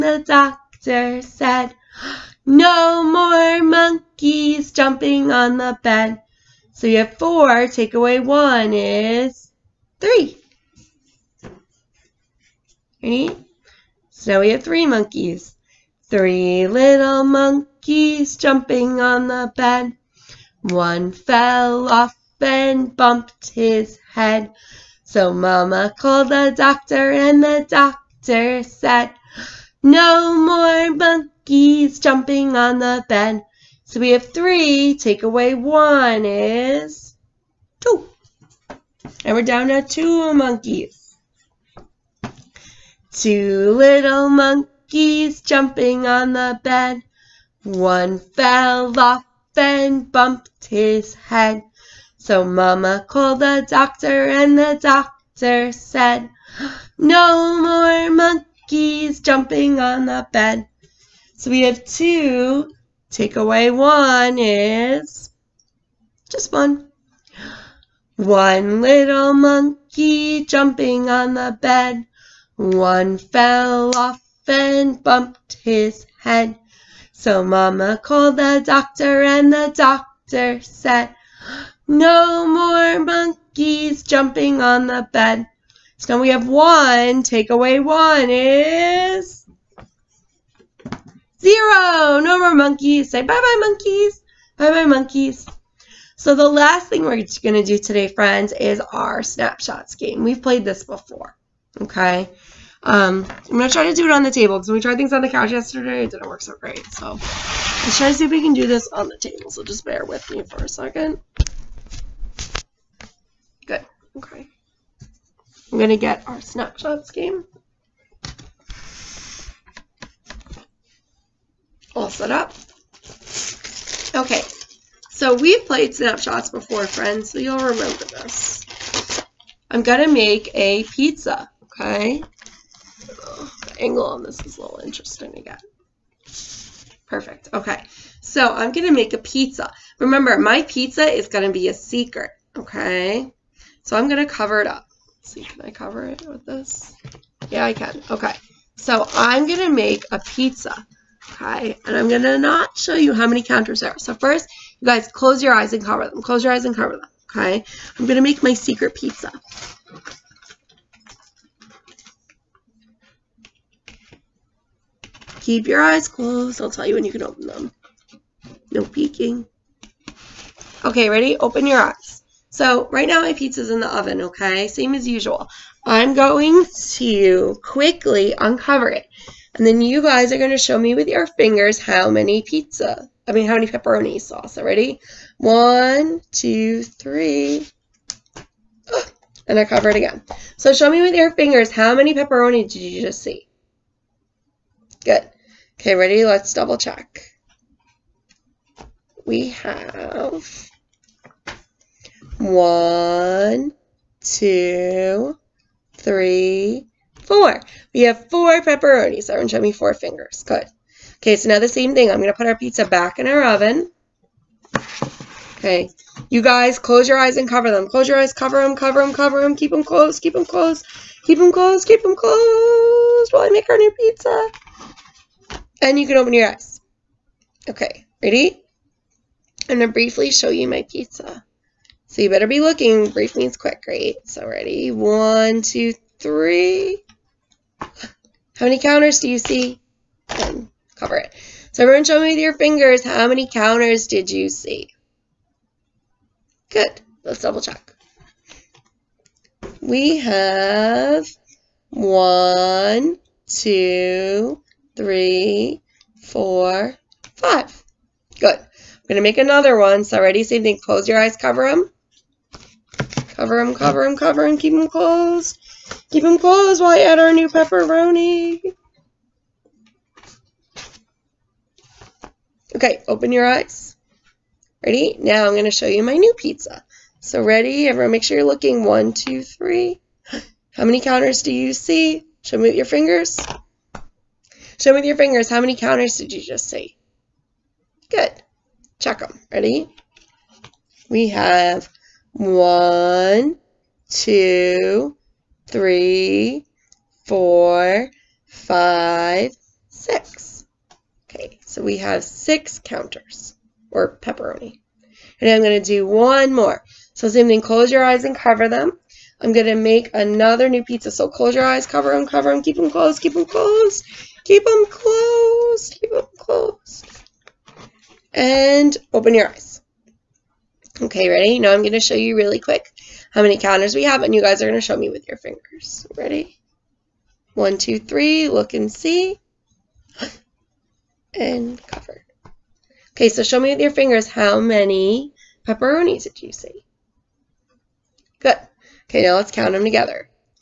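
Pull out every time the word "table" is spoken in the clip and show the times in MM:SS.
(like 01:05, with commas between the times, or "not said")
01:44, 01:49.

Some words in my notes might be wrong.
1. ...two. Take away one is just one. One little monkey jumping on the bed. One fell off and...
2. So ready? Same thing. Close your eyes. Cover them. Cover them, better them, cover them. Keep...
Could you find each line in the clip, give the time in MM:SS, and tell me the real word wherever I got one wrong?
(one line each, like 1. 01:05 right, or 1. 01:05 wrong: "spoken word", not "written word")
1. 01:01 right
2. 04:20 wrong: "cover", not "better".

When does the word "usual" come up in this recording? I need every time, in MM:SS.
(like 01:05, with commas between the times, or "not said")
02:55.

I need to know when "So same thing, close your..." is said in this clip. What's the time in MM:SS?
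05:07.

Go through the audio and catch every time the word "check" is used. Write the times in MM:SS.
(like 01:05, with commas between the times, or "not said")
03:16, 04:07, 04:48.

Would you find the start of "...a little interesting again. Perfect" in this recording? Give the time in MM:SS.
02:14.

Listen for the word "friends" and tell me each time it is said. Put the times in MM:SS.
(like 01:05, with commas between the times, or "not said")
01:38, 02:06.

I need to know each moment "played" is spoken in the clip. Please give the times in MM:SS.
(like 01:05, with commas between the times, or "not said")
01:40, 02:05.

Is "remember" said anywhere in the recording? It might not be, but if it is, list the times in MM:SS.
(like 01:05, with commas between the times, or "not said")
02:07, 02:19.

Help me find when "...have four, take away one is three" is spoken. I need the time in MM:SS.
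00:06.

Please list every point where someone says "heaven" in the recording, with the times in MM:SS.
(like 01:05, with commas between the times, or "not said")
not said.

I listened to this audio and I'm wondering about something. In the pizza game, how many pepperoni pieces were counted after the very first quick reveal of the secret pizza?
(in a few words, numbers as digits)
4.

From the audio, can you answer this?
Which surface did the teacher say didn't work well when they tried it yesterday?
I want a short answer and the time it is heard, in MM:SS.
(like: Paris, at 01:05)
the couch, at 01:45.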